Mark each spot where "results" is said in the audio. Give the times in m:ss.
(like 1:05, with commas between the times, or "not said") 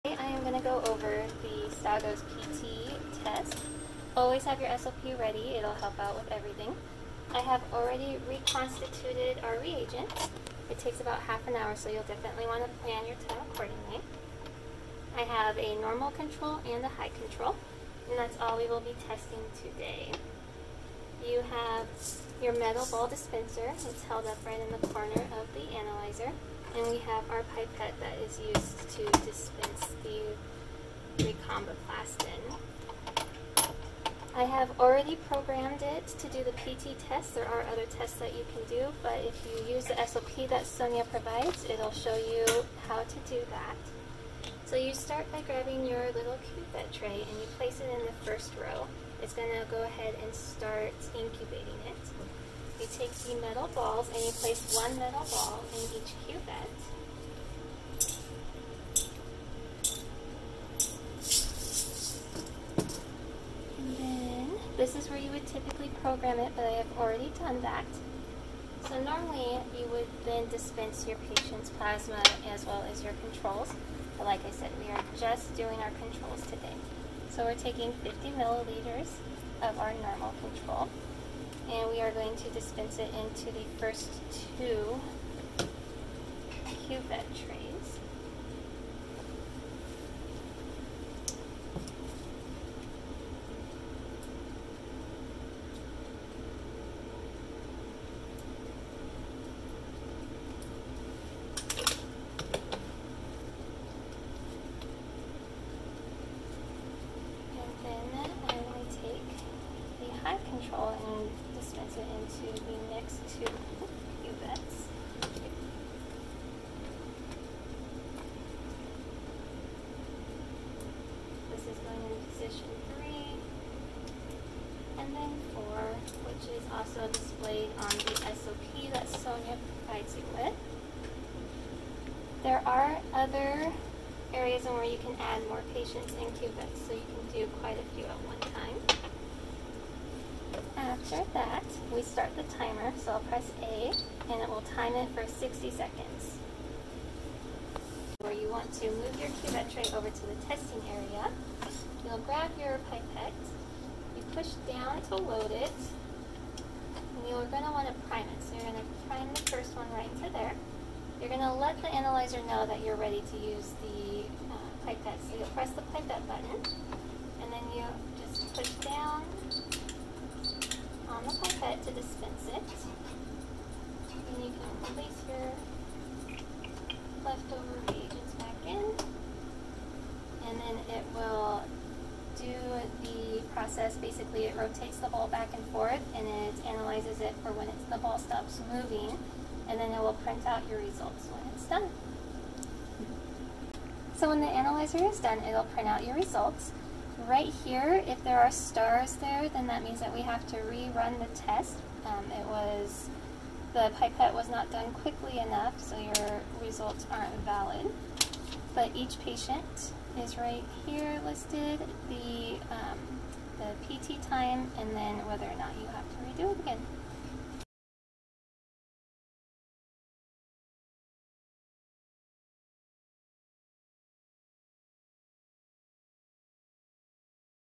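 3:10, 3:16, 3:26.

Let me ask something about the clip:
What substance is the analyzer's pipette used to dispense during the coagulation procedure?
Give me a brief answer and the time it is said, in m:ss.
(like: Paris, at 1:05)
thromboplastin, at 0:31.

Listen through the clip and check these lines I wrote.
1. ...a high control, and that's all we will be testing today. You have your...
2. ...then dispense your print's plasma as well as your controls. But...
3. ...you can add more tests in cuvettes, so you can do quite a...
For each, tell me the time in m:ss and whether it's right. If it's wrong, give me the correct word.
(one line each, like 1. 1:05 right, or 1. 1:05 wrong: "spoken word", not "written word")
1. 0:16 right
2. 1:10 wrong: "patient", not "print"
3. 2:14 wrong: "patients", not "tests".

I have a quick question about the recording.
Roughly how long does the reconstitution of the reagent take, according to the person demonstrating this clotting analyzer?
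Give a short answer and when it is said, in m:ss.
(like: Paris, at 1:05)
half an hour, at 0:11.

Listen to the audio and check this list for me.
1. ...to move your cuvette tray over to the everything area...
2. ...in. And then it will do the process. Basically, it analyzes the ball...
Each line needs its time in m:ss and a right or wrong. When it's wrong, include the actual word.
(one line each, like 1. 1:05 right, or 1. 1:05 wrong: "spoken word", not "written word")
1. 2:28 wrong: "testing", not "everything"
2. 2:58 wrong: "rotates", not "analyzes".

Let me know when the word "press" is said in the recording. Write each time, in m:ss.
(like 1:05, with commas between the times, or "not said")
2:23, 2:45.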